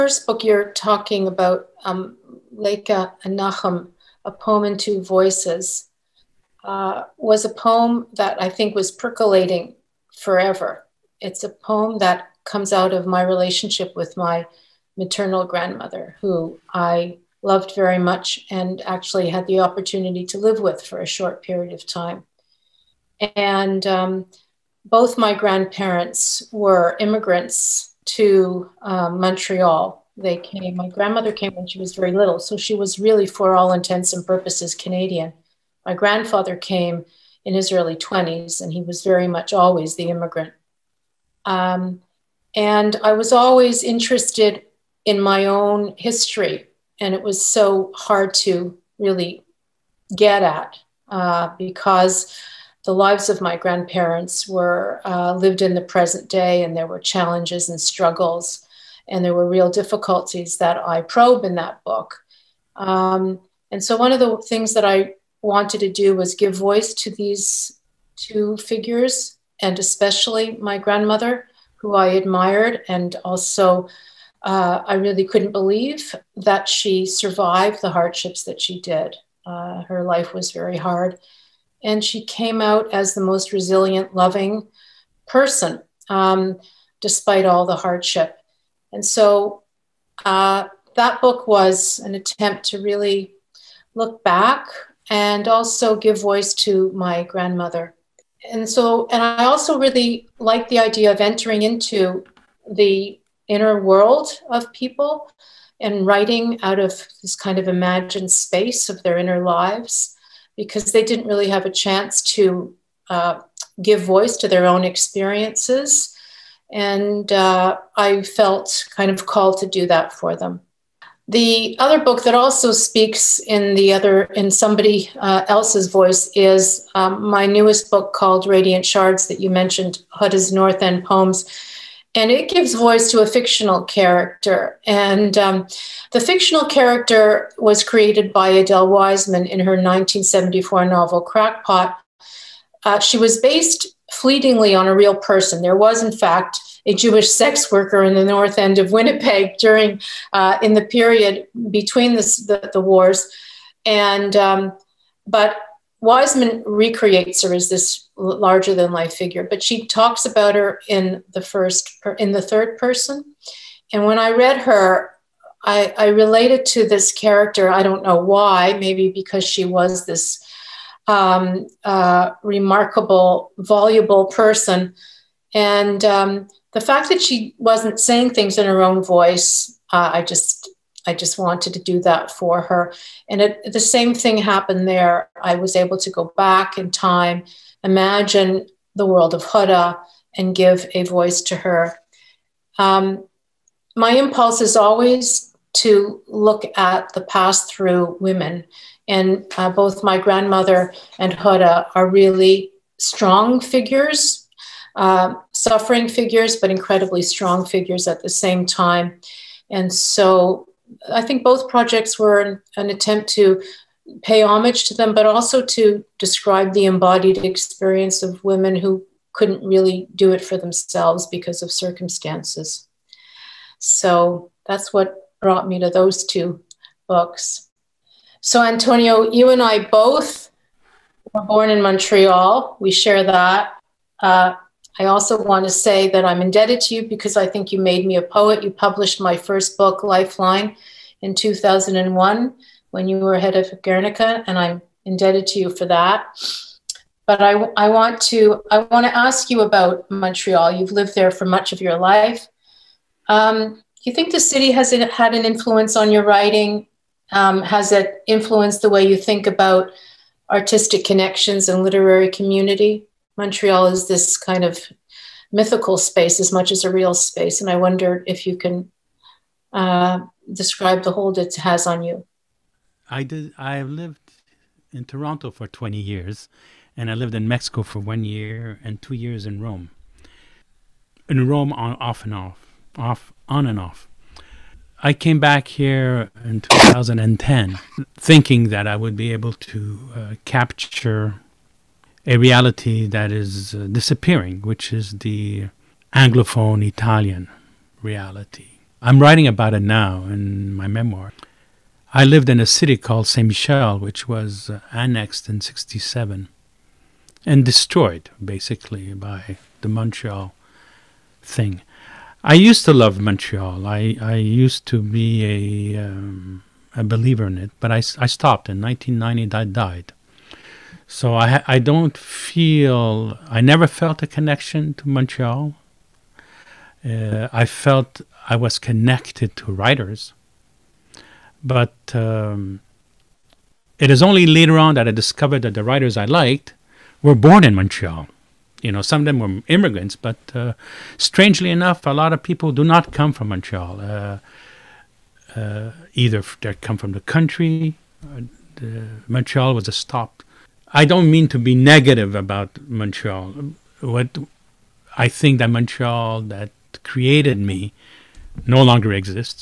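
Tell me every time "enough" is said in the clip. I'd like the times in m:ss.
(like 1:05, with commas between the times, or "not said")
5:41.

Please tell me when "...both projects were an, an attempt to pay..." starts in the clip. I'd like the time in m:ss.
3:31.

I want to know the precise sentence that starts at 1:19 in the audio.
Uh, her life was very hard and she came out as the most resilient, loving person, um, despite all the hardship.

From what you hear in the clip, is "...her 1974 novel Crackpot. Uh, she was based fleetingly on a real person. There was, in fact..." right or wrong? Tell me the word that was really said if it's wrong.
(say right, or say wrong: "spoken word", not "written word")
right.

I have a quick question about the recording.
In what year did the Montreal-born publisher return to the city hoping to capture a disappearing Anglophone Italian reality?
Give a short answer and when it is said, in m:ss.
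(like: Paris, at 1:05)
2010, at 4:46.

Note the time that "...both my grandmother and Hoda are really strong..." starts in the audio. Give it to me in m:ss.
3:19.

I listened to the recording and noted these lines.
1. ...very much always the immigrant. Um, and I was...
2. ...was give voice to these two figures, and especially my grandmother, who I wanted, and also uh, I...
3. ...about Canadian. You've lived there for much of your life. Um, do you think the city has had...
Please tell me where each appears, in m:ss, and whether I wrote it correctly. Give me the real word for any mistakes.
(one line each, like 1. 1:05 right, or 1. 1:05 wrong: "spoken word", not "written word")
1. 0:39 right
2. 1:06 wrong: "admired", not "wanted"
3. 4:09 wrong: "Montreal", not "Canadian".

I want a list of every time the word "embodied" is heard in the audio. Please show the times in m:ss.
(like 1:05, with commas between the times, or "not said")
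3:36.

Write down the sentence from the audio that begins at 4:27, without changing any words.
And I wonder if you can uh, describe the hold it has on you.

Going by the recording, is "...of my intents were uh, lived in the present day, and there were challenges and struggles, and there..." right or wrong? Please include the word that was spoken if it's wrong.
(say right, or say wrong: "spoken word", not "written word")
wrong: "grandparents", not "intents".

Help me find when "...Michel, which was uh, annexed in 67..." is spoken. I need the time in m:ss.
5:03.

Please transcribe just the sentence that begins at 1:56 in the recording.
And uh, I felt kind of called to do that for them.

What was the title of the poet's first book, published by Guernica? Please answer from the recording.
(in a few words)
Lifeline.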